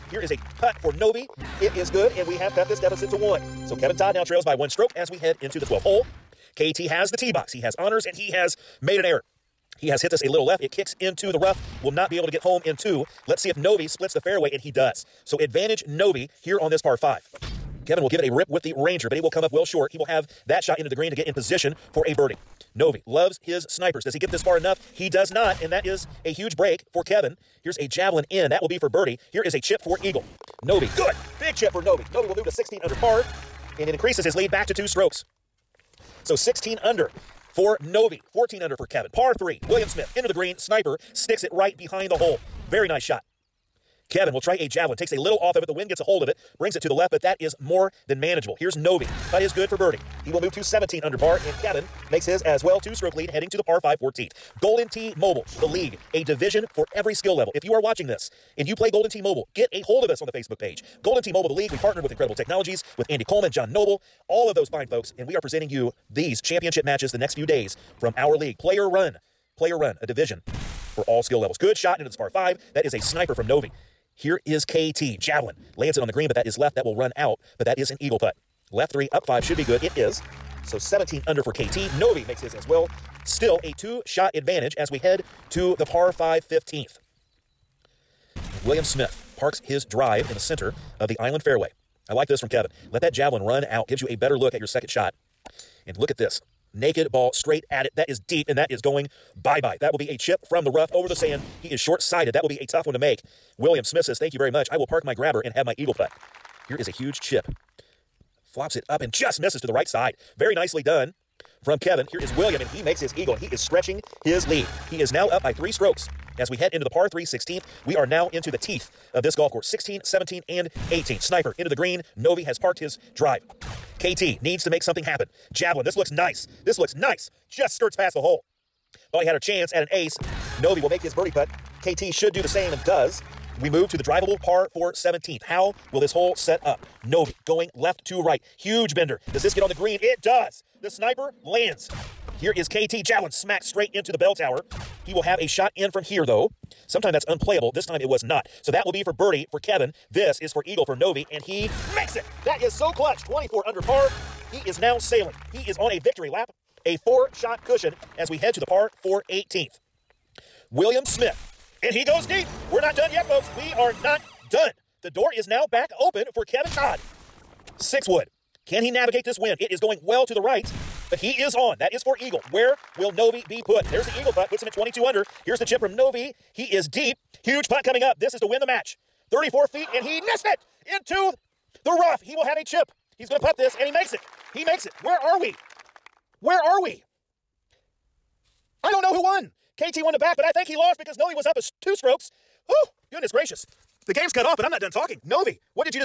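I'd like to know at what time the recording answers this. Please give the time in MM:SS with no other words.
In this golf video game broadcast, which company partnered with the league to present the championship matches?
01:02.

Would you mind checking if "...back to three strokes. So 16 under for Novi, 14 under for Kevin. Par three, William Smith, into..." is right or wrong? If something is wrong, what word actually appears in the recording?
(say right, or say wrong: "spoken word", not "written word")
wrong: "two", not "three".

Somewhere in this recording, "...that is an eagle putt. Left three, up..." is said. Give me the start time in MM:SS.
01:17.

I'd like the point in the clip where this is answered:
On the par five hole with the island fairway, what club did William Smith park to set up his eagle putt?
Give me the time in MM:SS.
01:45.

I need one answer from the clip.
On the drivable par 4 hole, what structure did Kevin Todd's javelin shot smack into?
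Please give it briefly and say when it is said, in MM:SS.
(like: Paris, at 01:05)
bell tower, at 02:24.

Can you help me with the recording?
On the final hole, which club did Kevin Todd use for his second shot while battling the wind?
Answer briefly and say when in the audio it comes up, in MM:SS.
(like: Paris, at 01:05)
Six wood, at 02:47.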